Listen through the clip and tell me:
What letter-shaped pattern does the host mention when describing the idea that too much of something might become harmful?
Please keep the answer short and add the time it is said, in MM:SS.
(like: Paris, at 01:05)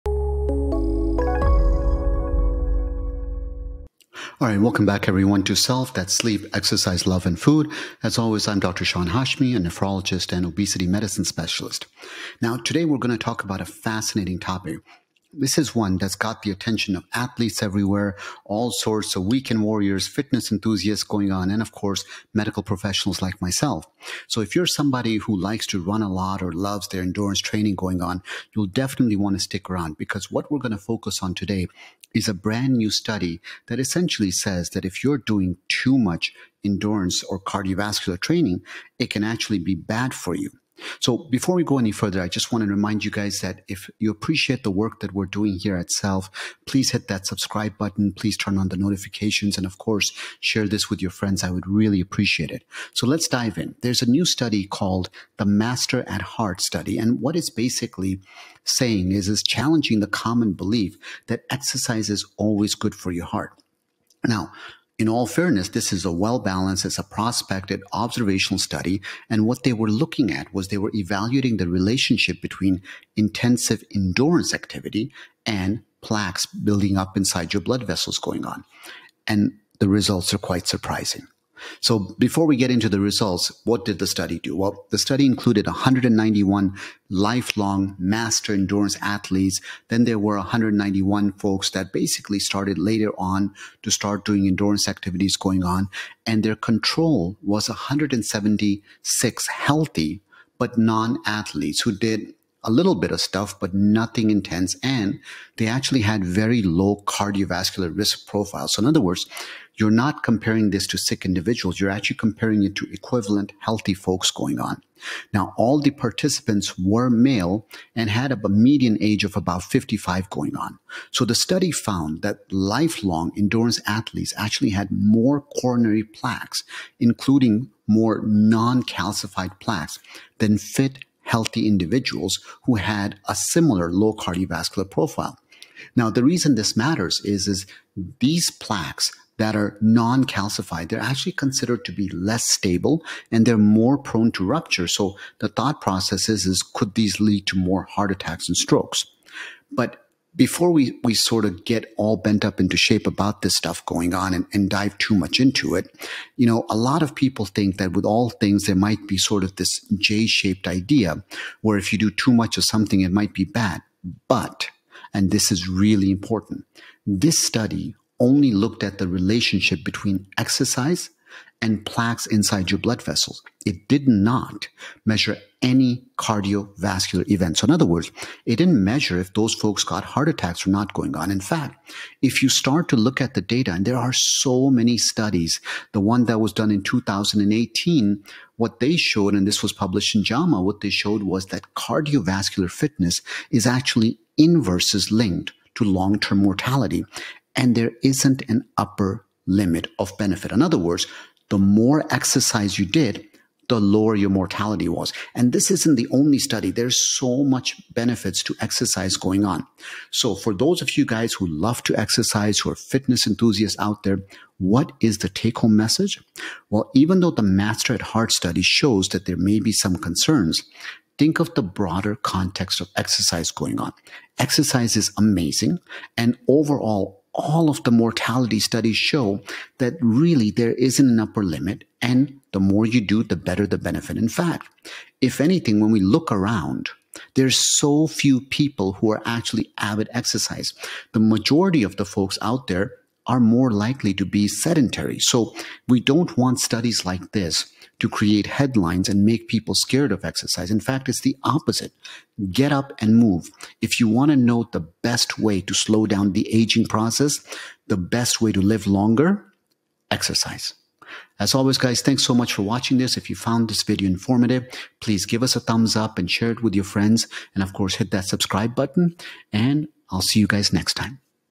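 J shaped, at 02:39.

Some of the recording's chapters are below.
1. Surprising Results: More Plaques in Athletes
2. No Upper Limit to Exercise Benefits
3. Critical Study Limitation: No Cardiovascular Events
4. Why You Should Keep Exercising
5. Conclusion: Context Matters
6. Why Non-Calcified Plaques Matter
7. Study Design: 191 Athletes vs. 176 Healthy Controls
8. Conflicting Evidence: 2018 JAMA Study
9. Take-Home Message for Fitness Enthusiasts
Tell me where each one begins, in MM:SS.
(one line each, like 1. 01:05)
1. 01:20
2. 03:21
3. 02:47
4. 04:07
5. 04:24
6. 02:30
7. 01:00
8. 03:05
9. 03:37.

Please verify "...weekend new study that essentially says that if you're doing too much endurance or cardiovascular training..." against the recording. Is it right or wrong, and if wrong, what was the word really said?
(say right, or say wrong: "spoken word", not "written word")
wrong: "brand", not "weekend".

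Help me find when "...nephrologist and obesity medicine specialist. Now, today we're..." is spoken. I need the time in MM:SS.
00:09.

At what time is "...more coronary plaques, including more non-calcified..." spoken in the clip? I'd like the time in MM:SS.
02:04.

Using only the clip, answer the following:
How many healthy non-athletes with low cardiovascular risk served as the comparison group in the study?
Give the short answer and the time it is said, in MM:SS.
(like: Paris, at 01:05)
176, at 01:37.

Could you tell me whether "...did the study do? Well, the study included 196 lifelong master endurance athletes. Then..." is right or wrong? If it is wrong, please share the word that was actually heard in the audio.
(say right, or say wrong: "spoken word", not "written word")
wrong: "191", not "196".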